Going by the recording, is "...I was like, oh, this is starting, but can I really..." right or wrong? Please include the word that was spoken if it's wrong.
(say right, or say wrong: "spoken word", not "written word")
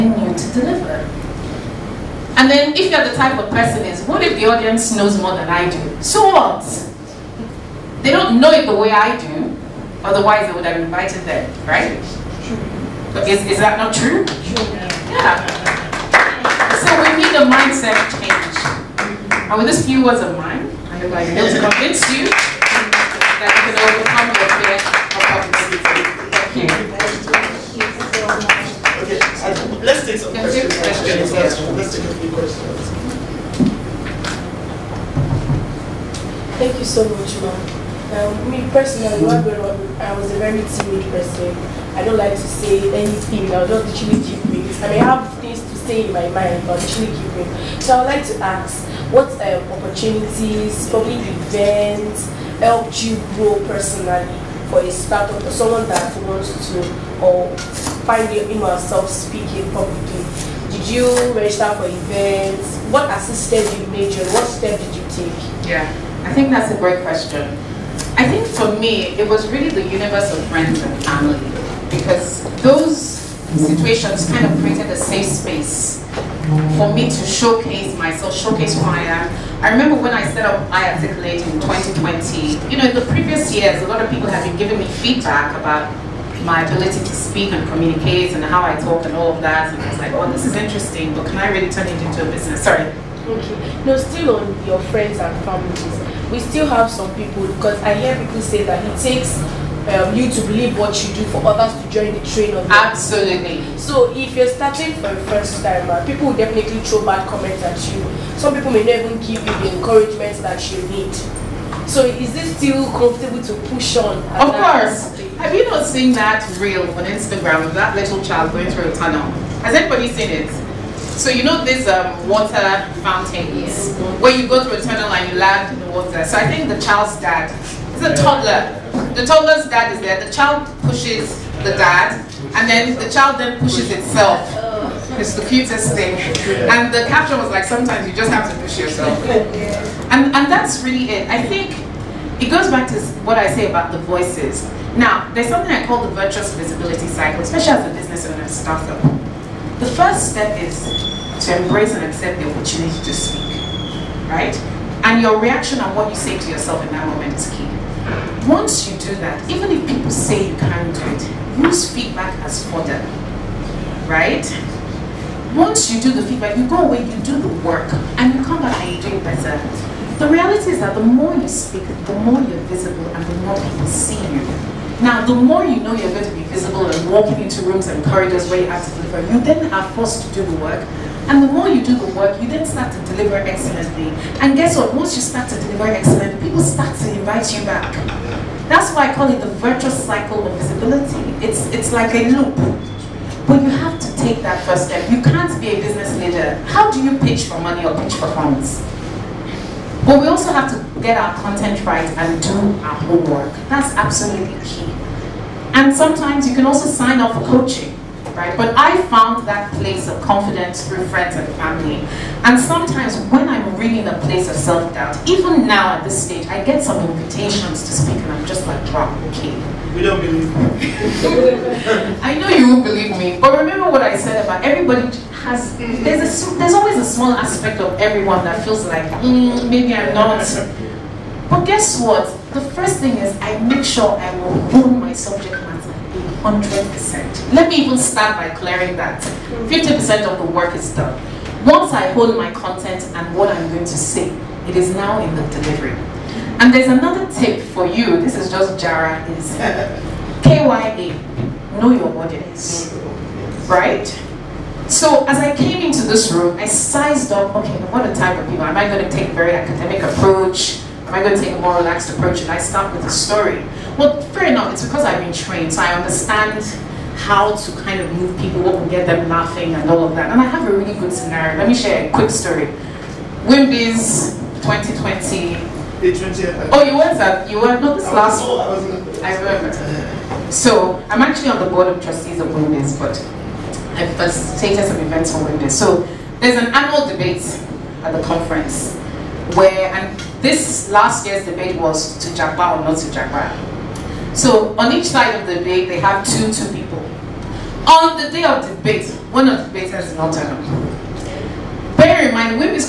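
wrong: "interesting", not "starting".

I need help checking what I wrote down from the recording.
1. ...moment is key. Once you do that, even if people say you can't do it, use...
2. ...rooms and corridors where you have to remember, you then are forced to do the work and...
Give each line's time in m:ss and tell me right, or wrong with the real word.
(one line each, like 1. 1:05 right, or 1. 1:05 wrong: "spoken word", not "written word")
1. 2:37 right
2. 2:57 wrong: "deliver", not "remember".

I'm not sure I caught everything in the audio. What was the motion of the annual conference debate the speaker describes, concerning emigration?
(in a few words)
To Japa or not to Japa.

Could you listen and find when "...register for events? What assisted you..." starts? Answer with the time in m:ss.
1:01.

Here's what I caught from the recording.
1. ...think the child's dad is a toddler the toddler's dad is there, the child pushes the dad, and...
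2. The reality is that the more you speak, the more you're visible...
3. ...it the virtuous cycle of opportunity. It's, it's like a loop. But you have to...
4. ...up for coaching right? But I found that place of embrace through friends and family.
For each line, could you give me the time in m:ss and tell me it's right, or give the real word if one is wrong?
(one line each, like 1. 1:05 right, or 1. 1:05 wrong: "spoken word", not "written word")
1. 2:06 right
2. 2:50 right
3. 3:09 wrong: "visibility", not "opportunity"
4. 3:27 wrong: "confidence", not "embrace".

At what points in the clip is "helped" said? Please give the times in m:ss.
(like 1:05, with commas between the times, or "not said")
0:52.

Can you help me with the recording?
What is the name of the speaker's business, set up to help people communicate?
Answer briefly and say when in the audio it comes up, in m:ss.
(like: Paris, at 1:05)
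I Articulate, at 1:20.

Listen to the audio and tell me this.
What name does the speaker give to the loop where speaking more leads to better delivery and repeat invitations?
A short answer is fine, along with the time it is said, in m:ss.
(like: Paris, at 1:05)
virtuous visibility cycle, at 2:26.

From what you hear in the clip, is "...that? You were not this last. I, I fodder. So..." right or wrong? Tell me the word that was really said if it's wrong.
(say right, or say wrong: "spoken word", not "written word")
wrong: "remember", not "fodder".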